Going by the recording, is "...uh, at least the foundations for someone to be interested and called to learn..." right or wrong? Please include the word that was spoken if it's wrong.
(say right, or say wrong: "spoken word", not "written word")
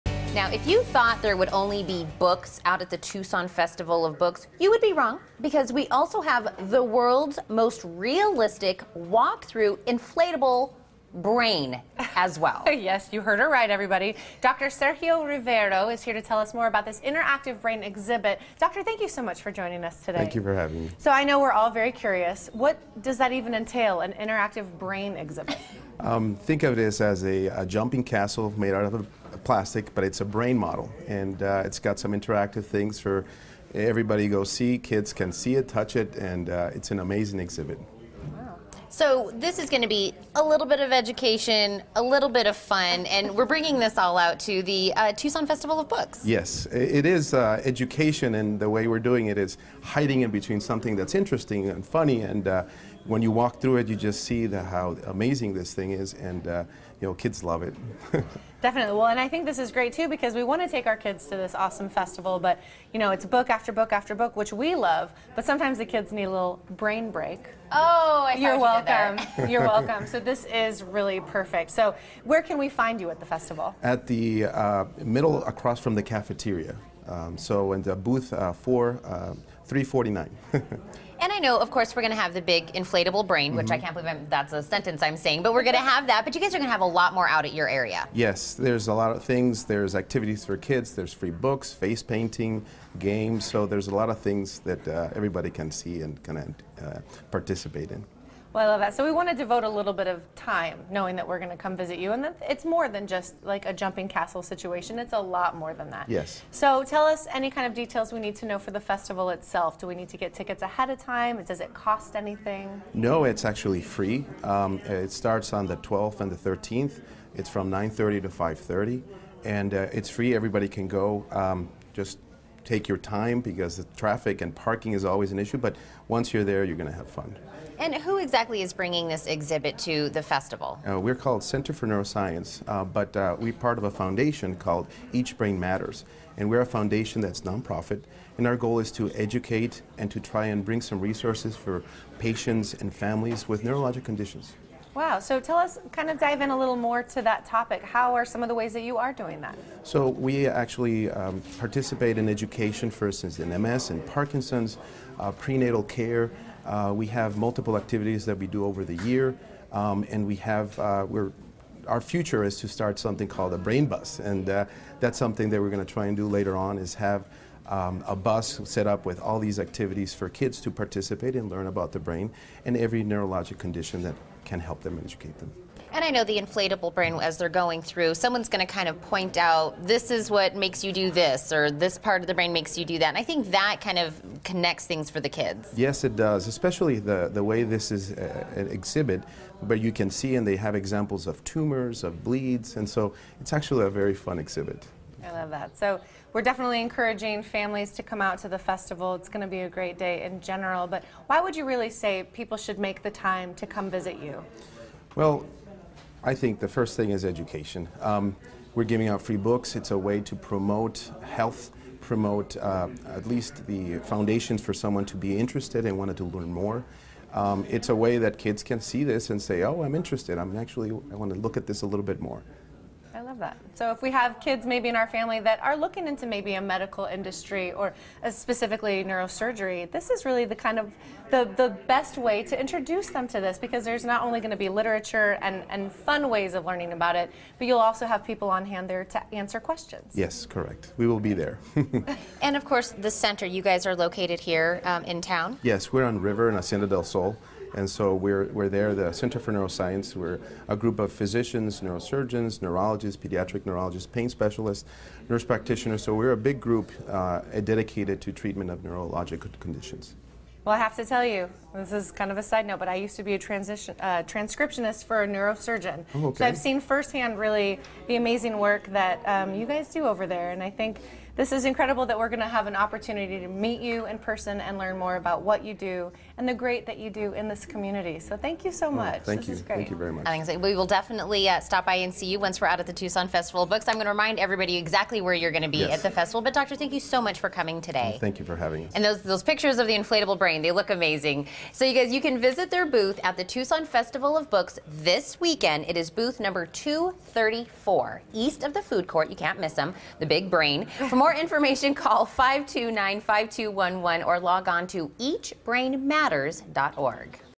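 wrong: "wanted", not "called".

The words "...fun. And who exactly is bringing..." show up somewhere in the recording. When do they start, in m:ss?
2:07.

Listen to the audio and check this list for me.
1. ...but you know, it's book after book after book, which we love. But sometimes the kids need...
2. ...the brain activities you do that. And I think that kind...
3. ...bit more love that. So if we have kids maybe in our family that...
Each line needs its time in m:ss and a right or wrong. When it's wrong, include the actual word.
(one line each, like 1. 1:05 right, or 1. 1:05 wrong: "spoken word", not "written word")
1. 1:02 right
2. 3:02 wrong: "makes", not "activities"
3. 3:42 right.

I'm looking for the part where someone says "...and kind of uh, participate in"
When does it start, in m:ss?
1:36.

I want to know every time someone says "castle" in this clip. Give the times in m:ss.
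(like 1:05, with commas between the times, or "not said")
0:28, 1:44.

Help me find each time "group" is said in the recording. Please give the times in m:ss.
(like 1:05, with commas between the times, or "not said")
4:10, 4:16.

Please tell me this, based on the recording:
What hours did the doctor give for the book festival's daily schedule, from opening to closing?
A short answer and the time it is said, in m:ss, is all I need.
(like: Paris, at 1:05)
9:30 to 5:30, at 1:57.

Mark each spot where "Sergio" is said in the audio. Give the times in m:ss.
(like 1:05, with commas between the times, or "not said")
0:14.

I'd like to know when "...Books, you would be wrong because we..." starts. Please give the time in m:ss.
0:04.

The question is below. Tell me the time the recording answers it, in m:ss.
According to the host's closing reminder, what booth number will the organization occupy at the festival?
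4:56.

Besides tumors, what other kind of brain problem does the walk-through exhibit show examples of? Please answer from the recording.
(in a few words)
bleeds.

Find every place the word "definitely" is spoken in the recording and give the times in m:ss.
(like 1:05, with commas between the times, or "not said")
0:58, 3:16, 4:40.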